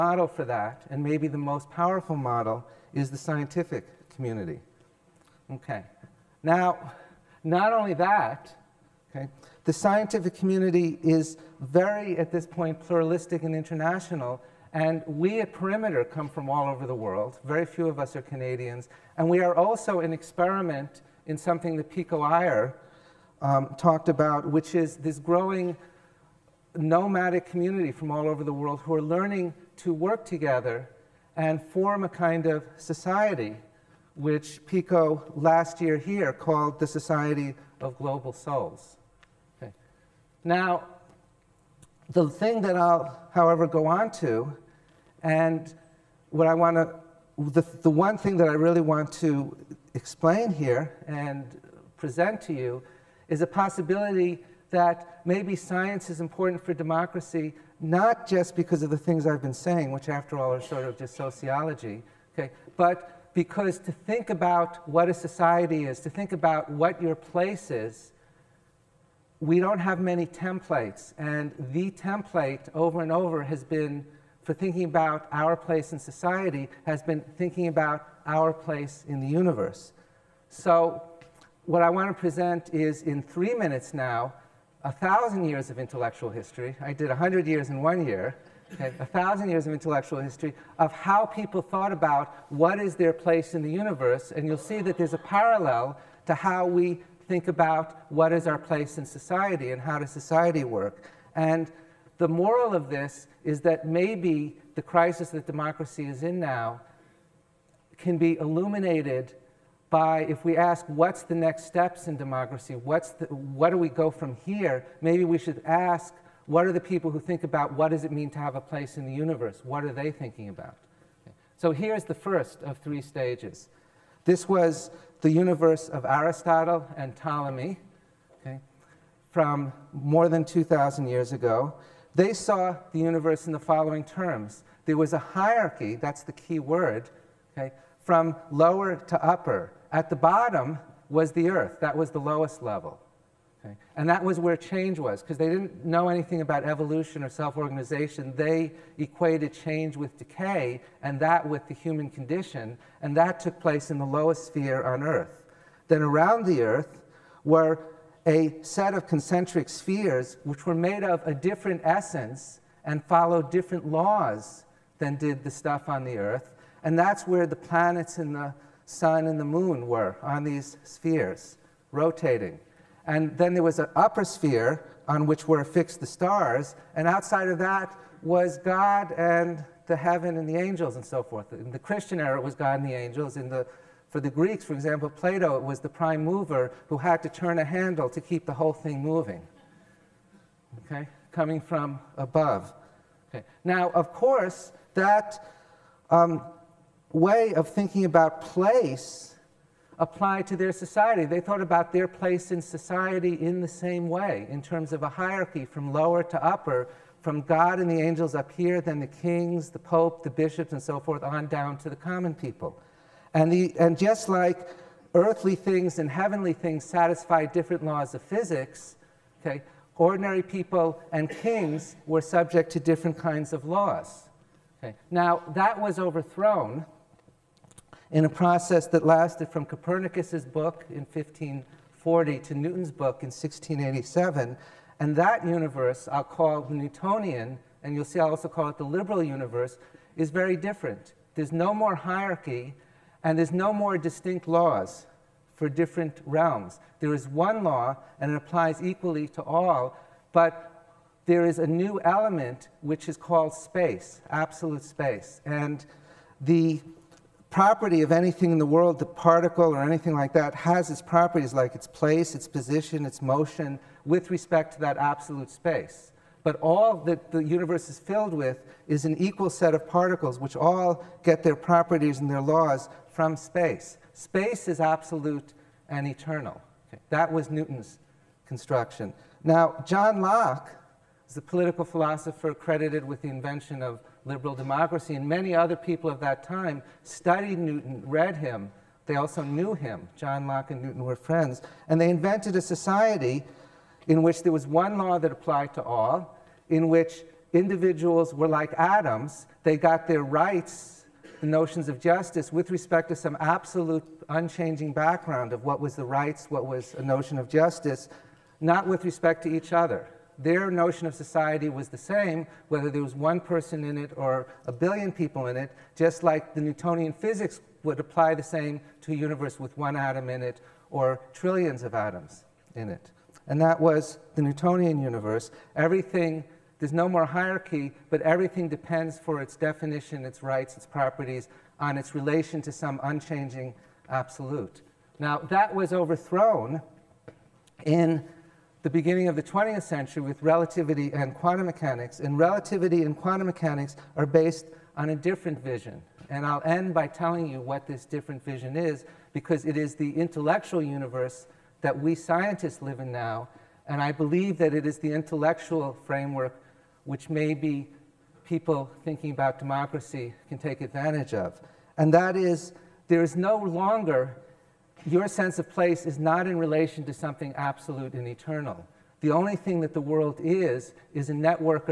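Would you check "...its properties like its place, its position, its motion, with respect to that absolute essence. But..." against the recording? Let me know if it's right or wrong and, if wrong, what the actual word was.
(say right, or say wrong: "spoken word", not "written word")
wrong: "space", not "essence".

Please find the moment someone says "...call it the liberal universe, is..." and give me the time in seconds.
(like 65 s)
238 s.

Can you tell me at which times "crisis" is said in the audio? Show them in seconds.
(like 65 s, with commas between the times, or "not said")
104 s.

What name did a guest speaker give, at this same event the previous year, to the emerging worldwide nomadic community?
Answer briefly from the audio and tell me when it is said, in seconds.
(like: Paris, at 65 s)
Society of Global Souls, at 36 s.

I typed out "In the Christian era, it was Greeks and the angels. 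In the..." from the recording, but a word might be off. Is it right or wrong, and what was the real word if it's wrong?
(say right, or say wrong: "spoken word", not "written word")
wrong: "God", not "Greeks".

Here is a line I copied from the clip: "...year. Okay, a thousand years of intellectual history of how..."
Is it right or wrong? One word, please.
right.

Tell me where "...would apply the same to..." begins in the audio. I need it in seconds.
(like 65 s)
317 s.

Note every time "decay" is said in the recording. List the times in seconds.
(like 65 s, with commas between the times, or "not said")
150 s.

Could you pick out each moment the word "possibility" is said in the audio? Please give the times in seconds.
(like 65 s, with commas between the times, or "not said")
53 s.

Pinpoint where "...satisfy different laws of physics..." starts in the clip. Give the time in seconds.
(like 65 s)
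216 s.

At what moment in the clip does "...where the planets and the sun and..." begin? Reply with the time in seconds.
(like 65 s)
167 s.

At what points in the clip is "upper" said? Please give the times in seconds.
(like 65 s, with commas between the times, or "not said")
139 s, 173 s, 206 s.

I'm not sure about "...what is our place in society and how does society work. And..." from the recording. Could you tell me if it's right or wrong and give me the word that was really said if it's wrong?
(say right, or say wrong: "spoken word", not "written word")
right.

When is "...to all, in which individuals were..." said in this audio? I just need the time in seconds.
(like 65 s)
295 s.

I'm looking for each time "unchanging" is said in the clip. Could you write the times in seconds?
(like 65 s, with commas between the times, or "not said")
304 s, 333 s.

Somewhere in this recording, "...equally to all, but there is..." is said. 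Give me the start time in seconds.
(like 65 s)
248 s.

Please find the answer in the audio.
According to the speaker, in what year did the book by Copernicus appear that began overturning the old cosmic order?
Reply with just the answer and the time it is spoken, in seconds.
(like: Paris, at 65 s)
1540, at 230 s.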